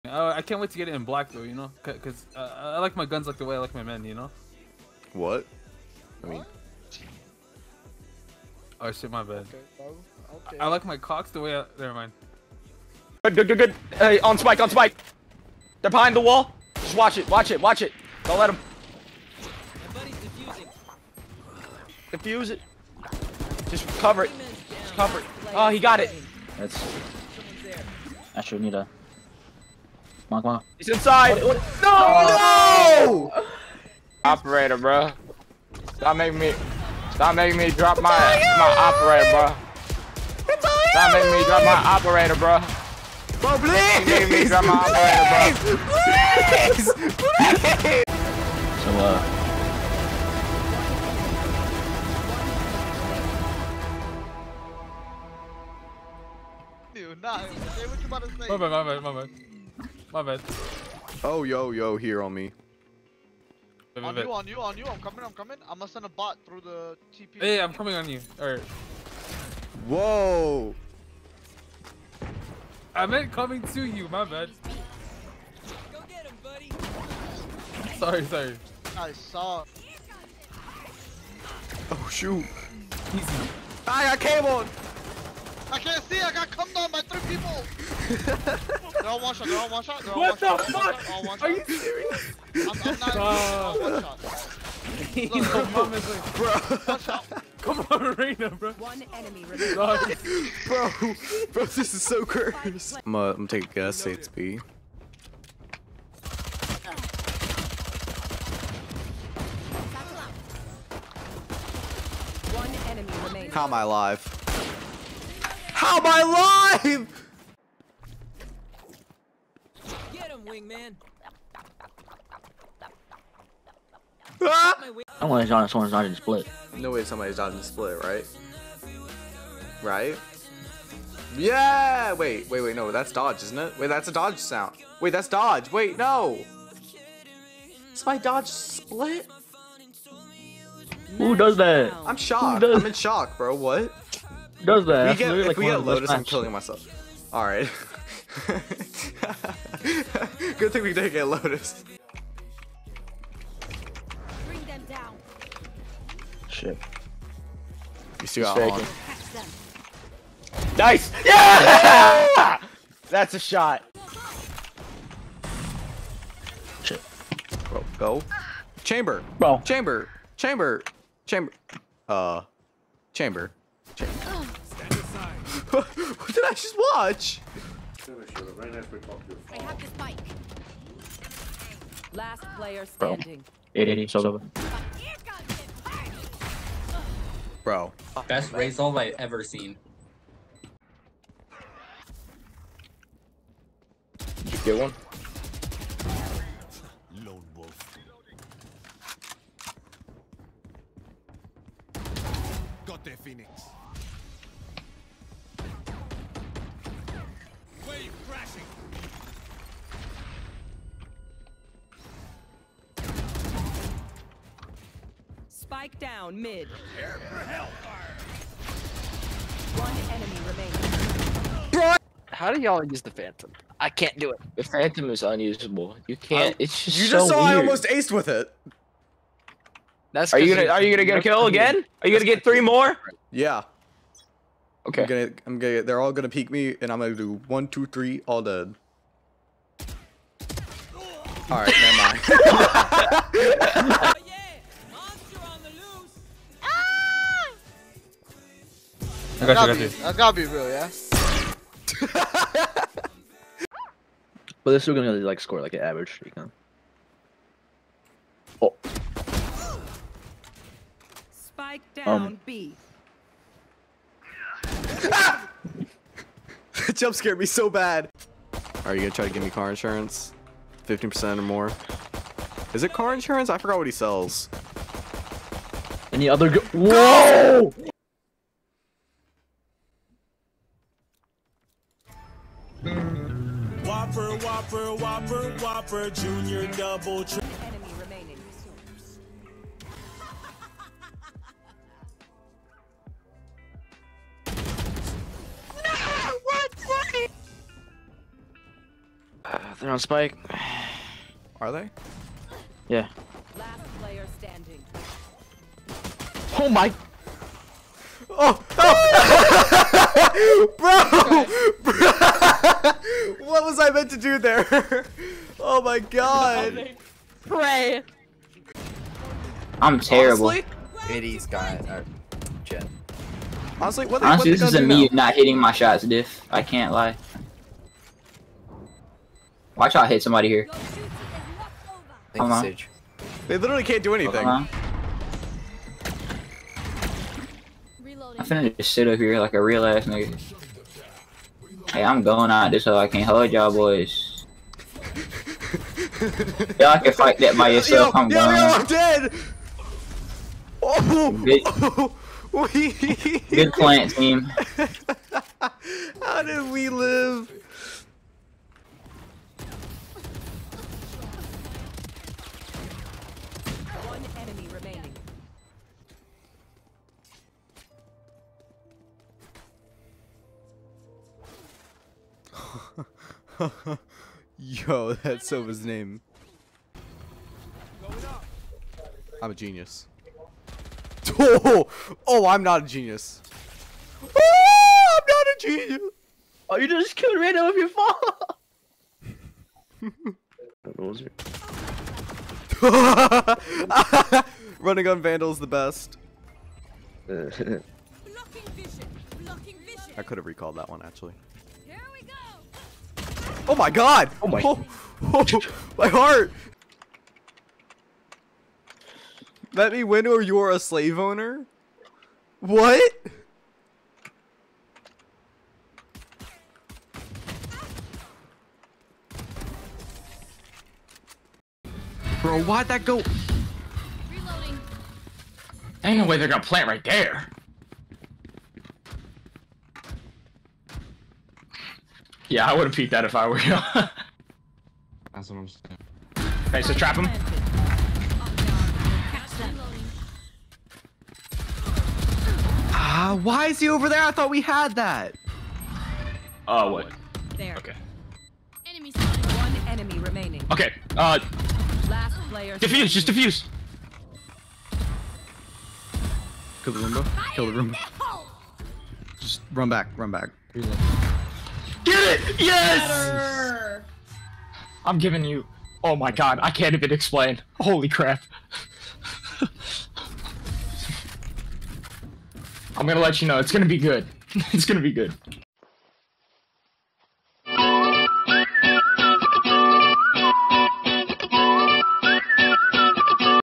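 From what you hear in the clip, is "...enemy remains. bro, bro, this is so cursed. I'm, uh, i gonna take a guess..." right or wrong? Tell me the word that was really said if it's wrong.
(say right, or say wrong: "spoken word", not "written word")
right.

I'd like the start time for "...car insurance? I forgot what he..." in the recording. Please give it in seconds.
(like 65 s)
272 s.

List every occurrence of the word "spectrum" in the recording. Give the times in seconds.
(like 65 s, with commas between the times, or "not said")
not said.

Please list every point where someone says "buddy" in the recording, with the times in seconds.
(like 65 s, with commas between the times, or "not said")
76 s.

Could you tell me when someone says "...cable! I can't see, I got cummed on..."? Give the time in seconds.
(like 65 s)
84 s.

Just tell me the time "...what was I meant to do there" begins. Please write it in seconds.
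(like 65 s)
313 s.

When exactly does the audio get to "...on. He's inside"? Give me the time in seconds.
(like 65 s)
30 s.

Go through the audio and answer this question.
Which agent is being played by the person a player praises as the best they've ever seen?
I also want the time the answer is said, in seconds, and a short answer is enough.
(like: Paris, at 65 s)
Raze, at 188 s.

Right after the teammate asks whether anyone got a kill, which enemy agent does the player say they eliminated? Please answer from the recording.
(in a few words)
Phoenix.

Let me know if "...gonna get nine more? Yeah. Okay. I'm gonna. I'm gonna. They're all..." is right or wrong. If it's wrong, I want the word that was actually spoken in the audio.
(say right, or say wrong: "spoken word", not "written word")
wrong: "three", not "nine".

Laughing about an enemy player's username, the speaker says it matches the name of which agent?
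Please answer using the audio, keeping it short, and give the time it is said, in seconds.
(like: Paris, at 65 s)
Sova, at 375 s.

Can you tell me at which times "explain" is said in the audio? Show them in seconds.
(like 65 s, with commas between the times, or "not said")
467 s.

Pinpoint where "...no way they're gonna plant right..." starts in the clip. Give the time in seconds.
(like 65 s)
426 s.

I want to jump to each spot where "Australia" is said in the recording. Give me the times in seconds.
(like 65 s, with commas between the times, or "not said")
not said.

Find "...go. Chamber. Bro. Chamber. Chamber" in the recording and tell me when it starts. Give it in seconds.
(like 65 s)
167 s.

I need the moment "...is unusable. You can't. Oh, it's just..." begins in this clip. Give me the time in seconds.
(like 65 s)
225 s.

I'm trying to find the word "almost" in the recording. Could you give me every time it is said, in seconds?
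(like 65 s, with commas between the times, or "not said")
227 s.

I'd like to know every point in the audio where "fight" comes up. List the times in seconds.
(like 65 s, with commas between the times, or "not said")
347 s.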